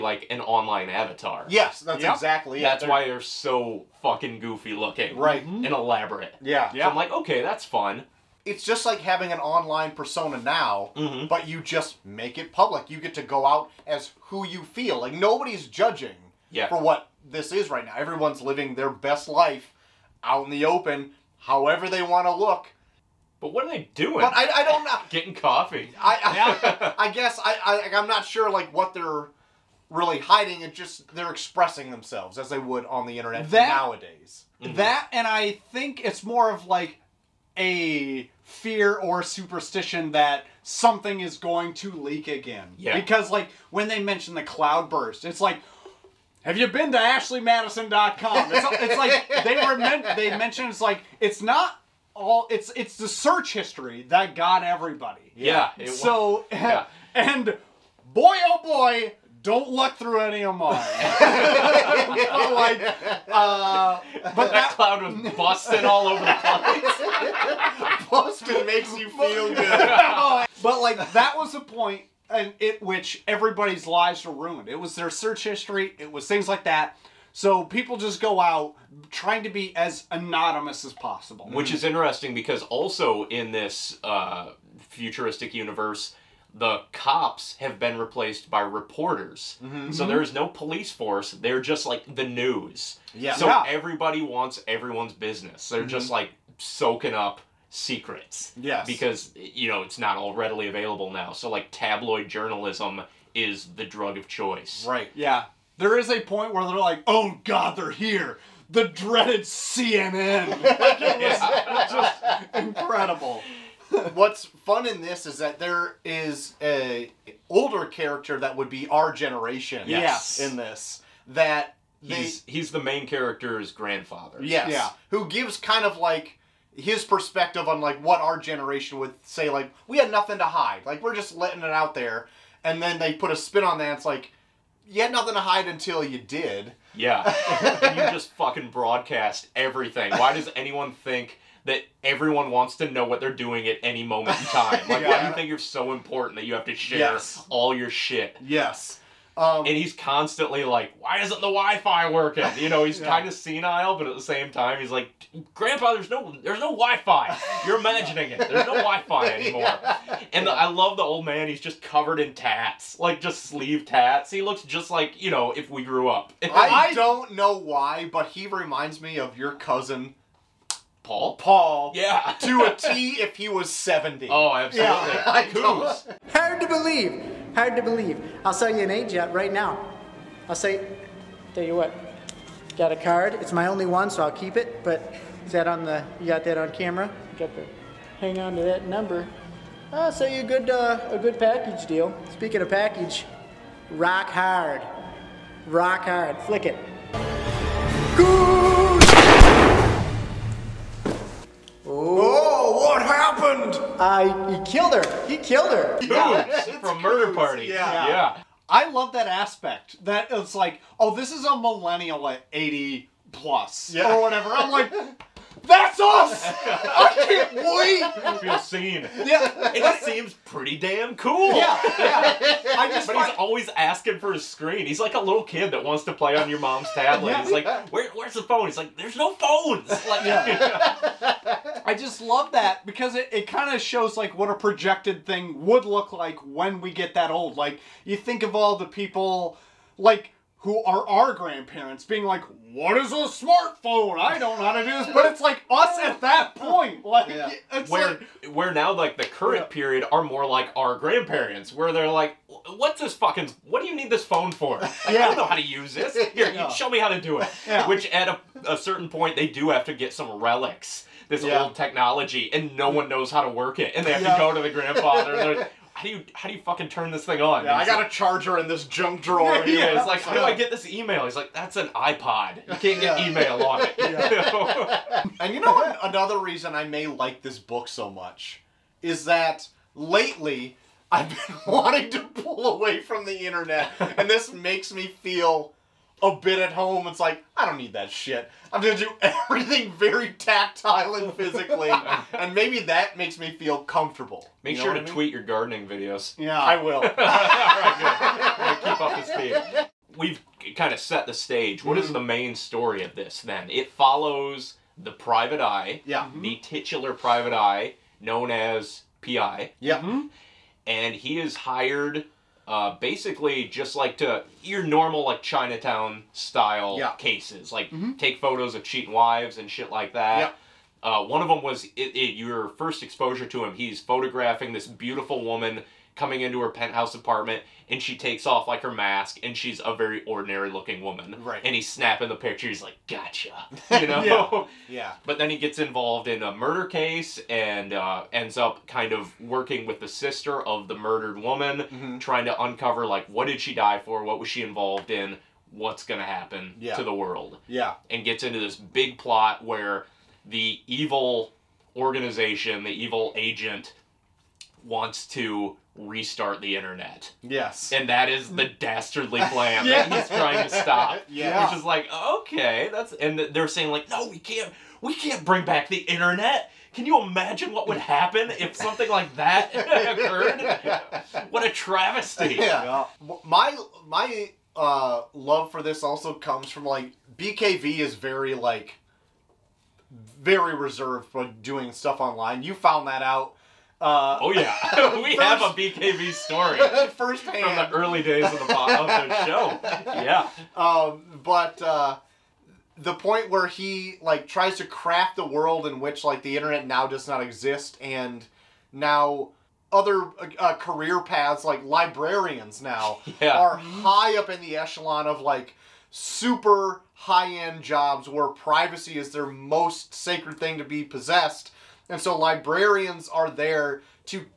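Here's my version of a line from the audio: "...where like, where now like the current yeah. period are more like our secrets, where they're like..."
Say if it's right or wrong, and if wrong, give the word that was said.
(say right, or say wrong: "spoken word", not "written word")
wrong: "grandparents", not "secrets".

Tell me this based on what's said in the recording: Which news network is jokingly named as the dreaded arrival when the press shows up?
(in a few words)
CNN.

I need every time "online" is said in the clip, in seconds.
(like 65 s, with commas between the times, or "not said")
0 s, 9 s, 382 s.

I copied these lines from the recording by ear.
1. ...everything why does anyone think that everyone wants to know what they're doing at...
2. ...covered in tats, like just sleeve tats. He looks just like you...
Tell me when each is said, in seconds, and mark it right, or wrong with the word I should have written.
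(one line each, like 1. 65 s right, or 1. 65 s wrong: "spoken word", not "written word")
1. 139 s right
2. 161 s right.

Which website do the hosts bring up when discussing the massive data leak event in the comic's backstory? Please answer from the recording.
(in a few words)
ashleymadison.com.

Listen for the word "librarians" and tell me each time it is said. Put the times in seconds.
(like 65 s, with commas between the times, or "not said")
401 s, 412 s.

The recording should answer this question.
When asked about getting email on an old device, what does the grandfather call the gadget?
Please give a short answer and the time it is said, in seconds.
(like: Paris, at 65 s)
An iPod, at 271 s.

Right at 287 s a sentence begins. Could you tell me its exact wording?
It's like, I don't need that shit.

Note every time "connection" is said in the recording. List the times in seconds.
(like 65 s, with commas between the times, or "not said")
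not said.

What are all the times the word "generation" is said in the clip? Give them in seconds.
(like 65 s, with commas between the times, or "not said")
119 s, 128 s.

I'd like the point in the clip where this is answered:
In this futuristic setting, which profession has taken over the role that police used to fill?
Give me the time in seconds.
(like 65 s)
88 s.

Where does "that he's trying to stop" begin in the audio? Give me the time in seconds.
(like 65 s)
360 s.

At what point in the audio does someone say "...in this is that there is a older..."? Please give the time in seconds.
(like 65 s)
114 s.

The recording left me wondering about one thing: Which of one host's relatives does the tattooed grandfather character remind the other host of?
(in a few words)
Cousin Paul.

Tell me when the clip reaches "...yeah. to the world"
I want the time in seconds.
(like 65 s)
346 s.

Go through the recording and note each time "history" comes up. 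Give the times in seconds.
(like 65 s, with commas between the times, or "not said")
53 s, 75 s.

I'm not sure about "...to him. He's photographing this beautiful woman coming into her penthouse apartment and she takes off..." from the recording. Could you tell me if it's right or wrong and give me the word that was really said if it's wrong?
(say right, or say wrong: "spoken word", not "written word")
right.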